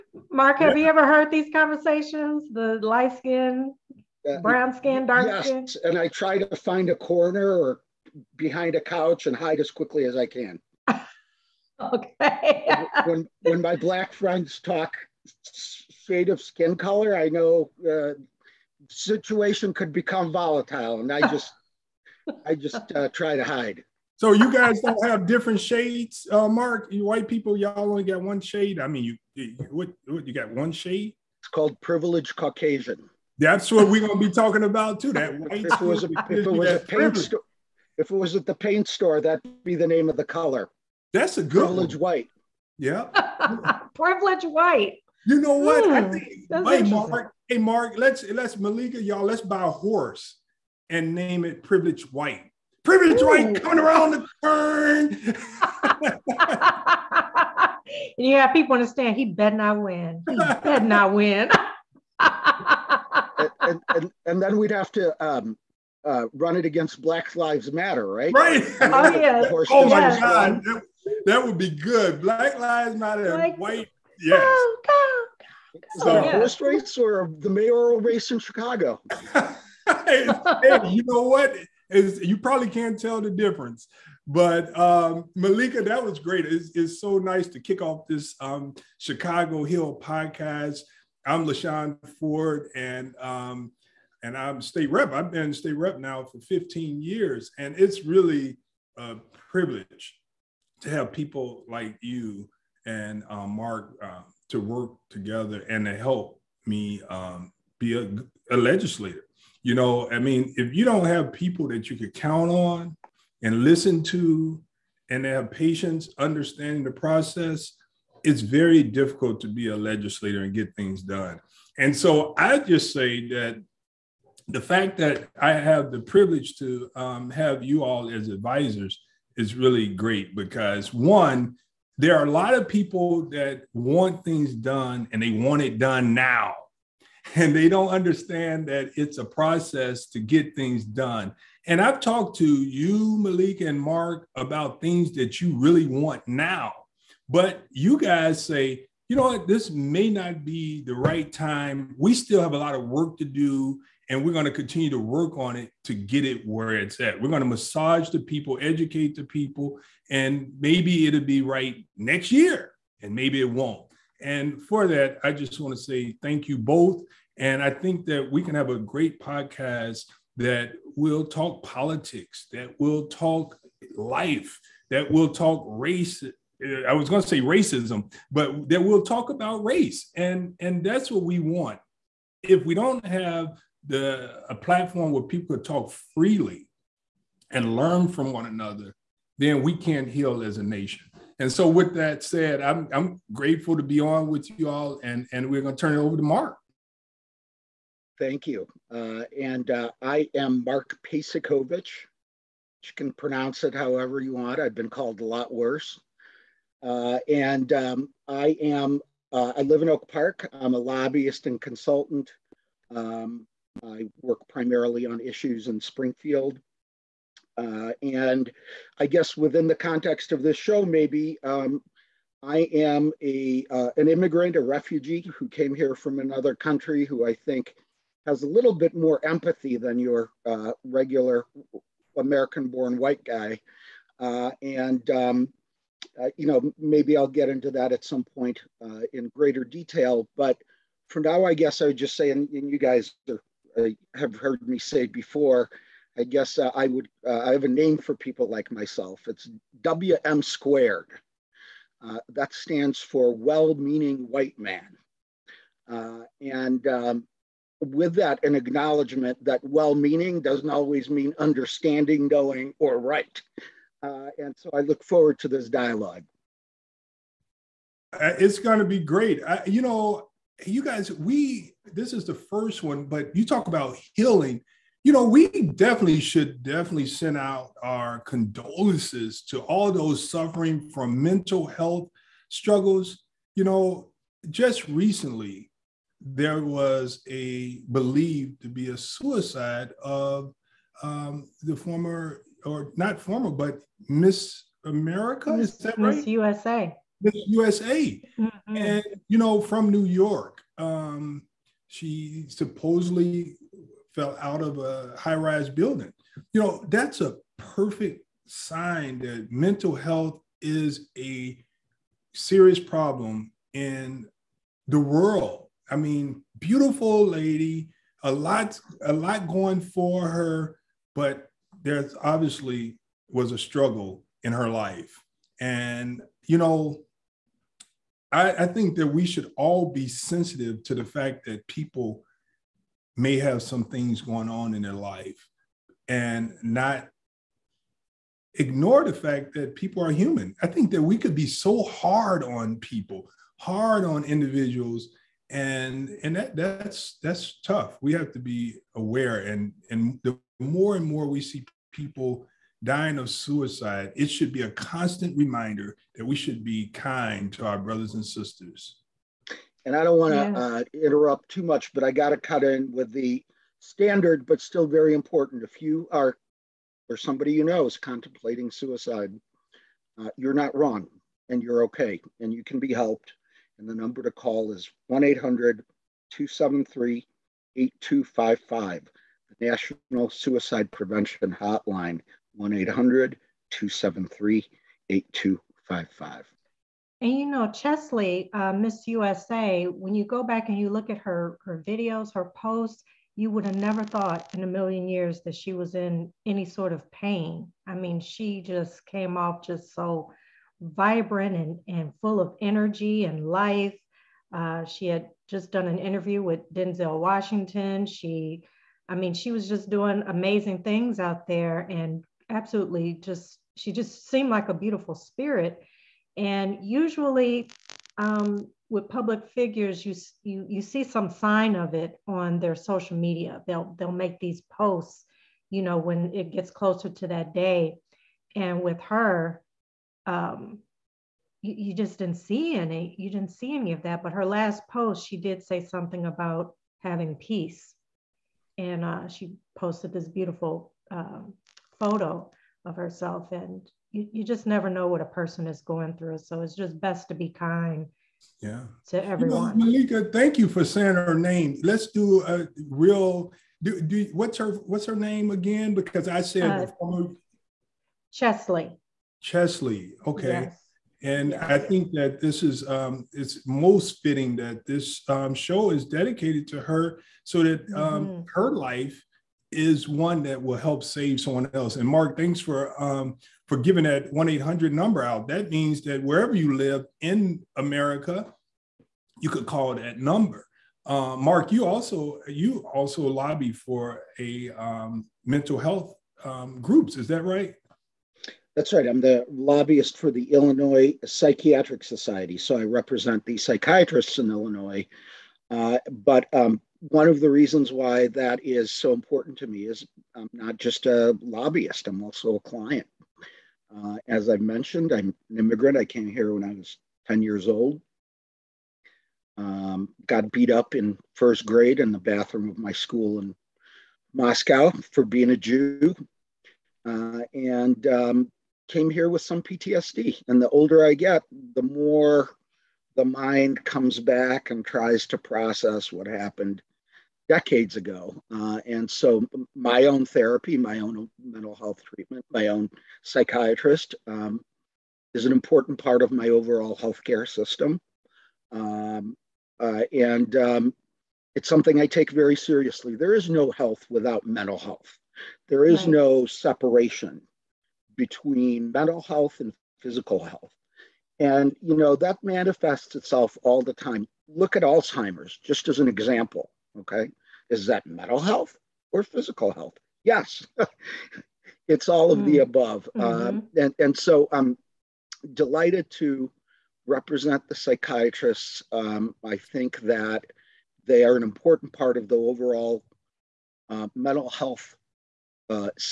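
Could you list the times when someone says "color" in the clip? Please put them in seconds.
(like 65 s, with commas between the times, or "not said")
16 s, 40 s.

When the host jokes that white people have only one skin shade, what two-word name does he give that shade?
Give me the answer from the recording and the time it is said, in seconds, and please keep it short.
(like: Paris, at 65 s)
Privileged Caucasian, at 31 s.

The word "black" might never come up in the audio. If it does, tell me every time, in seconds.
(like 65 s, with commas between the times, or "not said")
13 s, 67 s, 72 s.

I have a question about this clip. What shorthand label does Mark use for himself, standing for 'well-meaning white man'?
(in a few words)
WM squared.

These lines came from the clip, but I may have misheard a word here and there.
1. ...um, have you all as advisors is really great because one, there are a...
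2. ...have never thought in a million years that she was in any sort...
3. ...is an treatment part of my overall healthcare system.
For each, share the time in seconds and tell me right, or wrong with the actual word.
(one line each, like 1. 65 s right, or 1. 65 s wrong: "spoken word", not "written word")
1. 126 s right
2. 393 s right
3. 535 s wrong: "important", not "treatment".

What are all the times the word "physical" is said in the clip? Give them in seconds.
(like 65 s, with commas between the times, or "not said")
550 s, 559 s.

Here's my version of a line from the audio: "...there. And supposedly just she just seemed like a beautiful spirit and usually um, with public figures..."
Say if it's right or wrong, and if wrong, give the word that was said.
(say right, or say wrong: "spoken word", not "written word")
wrong: "absolutely", not "supposedly".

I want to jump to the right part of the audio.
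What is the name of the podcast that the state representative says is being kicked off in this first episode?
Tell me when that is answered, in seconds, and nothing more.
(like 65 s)
88 s.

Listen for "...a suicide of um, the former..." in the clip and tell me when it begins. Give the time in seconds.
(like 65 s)
288 s.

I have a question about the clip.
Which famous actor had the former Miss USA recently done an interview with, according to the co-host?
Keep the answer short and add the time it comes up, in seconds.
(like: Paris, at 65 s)
Denzel Washington, at 406 s.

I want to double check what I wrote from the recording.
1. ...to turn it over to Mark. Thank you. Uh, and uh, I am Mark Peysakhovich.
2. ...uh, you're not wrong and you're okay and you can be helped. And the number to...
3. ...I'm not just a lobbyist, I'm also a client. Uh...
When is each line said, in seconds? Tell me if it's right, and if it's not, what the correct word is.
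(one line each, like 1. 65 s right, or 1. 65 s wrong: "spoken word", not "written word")
1. 195 s right
2. 370 s right
3. 500 s right.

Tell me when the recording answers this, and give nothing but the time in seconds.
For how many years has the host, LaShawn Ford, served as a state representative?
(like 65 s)
96 s.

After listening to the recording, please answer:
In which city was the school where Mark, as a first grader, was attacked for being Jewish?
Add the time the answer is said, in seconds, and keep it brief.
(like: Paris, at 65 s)
Moscow, at 514 s.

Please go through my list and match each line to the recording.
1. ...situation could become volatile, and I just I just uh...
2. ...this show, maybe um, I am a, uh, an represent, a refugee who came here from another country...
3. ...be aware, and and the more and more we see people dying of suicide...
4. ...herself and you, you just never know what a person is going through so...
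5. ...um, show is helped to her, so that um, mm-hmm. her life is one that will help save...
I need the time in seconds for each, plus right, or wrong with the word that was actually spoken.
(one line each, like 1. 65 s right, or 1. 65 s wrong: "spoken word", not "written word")
1. 18 s right
2. 220 s wrong: "immigrant", not "represent"
3. 348 s right
4. 442 s right
5. 465 s wrong: "dedicated", not "helped".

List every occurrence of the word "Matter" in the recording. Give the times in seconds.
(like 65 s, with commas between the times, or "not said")
67 s, 72 s.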